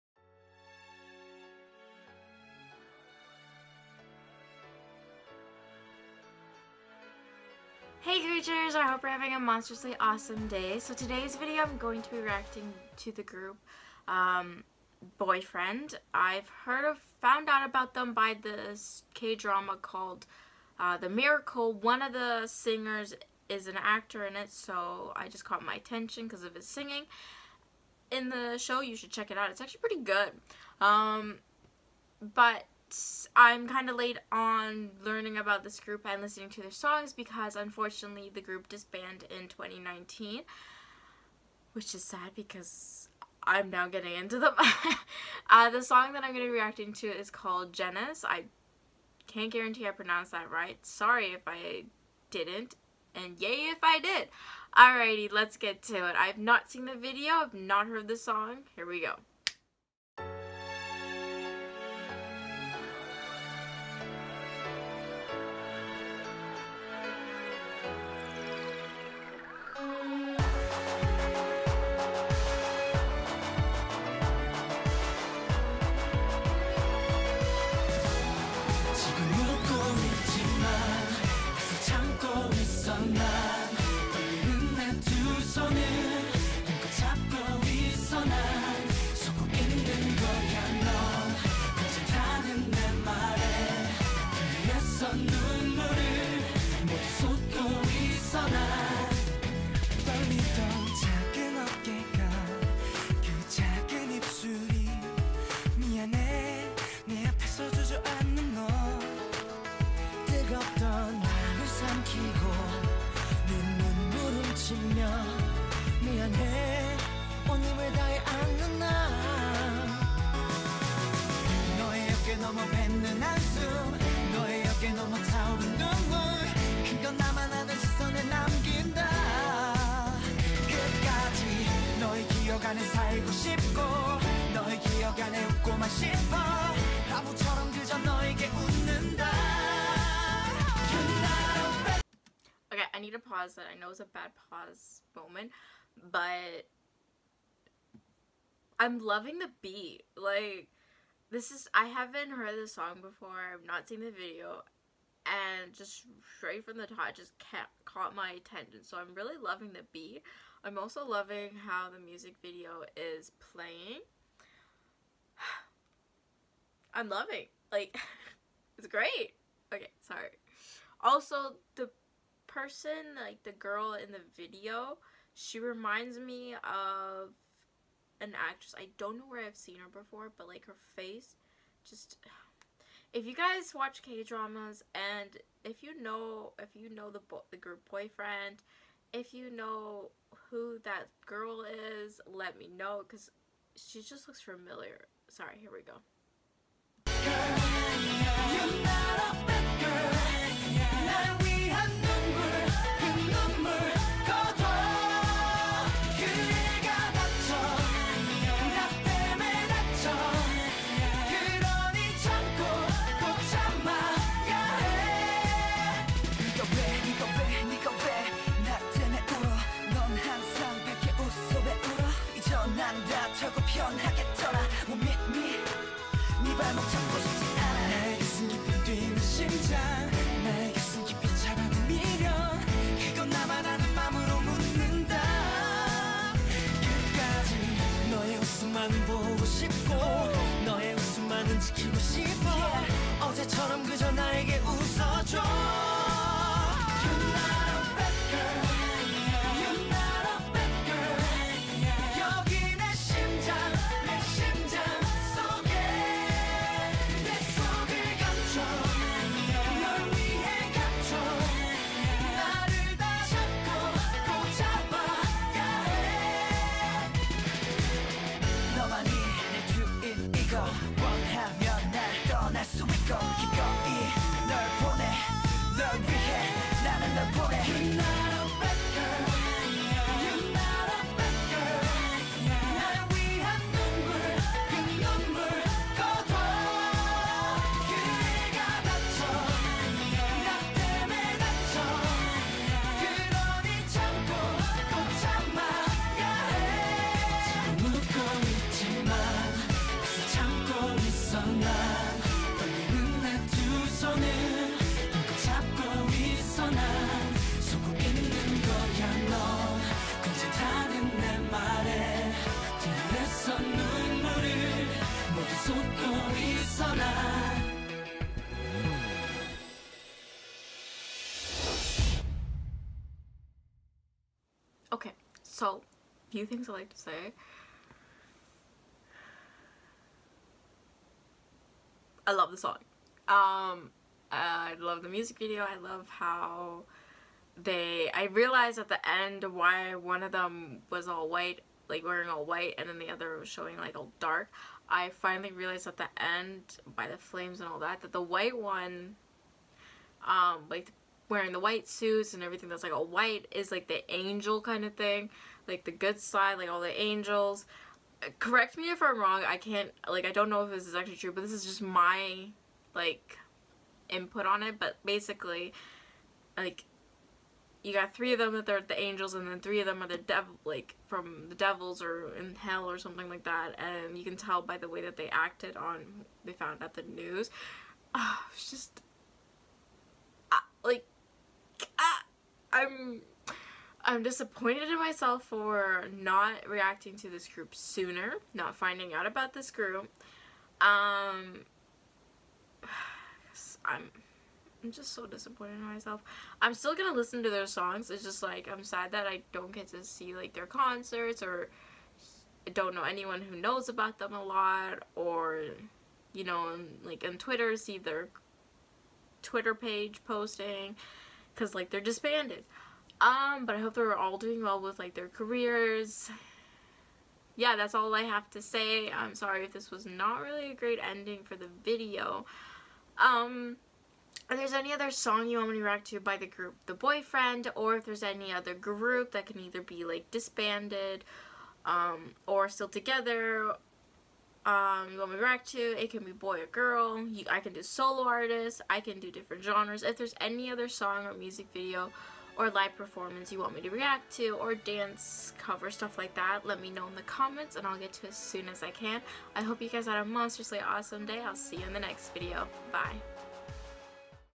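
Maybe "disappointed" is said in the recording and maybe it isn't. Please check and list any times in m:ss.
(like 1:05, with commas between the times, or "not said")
6:24, 6:35.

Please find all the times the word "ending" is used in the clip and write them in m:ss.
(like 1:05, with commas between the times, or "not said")
7:01.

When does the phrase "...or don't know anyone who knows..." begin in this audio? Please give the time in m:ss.
6:41.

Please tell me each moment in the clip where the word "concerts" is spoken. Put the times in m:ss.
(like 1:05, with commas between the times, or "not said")
6:40.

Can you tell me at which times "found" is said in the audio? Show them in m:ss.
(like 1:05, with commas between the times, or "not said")
0:17, 6:16.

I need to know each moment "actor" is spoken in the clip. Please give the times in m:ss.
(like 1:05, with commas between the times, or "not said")
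0:23.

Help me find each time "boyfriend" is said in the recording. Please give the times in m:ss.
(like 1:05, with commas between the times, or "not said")
0:15, 3:07, 7:06.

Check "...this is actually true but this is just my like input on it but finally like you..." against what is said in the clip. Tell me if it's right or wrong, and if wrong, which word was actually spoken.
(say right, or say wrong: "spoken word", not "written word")
wrong: "basically", not "finally".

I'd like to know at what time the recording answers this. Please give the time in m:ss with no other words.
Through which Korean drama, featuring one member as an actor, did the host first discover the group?
0:20.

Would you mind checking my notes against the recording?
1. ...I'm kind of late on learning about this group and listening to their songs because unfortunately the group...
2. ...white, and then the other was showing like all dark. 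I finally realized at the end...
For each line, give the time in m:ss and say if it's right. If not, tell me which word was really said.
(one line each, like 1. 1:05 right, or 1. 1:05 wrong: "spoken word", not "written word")
1. 0:33 right
2. 5:42 right.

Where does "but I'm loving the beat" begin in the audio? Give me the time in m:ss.
2:26.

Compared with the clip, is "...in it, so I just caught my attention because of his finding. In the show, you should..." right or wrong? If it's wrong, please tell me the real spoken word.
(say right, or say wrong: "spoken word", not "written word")
wrong: "singing", not "finding".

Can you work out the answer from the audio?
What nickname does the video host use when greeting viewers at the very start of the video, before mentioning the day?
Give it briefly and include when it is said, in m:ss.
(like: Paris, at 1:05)
Creatures, at 0:08.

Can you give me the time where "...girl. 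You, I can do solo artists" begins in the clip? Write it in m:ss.
7:16.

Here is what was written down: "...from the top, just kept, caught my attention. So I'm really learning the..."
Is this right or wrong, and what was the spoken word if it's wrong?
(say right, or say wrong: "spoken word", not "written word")
wrong: "loving", not "learning".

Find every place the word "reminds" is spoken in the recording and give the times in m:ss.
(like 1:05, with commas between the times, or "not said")
2:55.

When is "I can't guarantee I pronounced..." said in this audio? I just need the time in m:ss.
0:48.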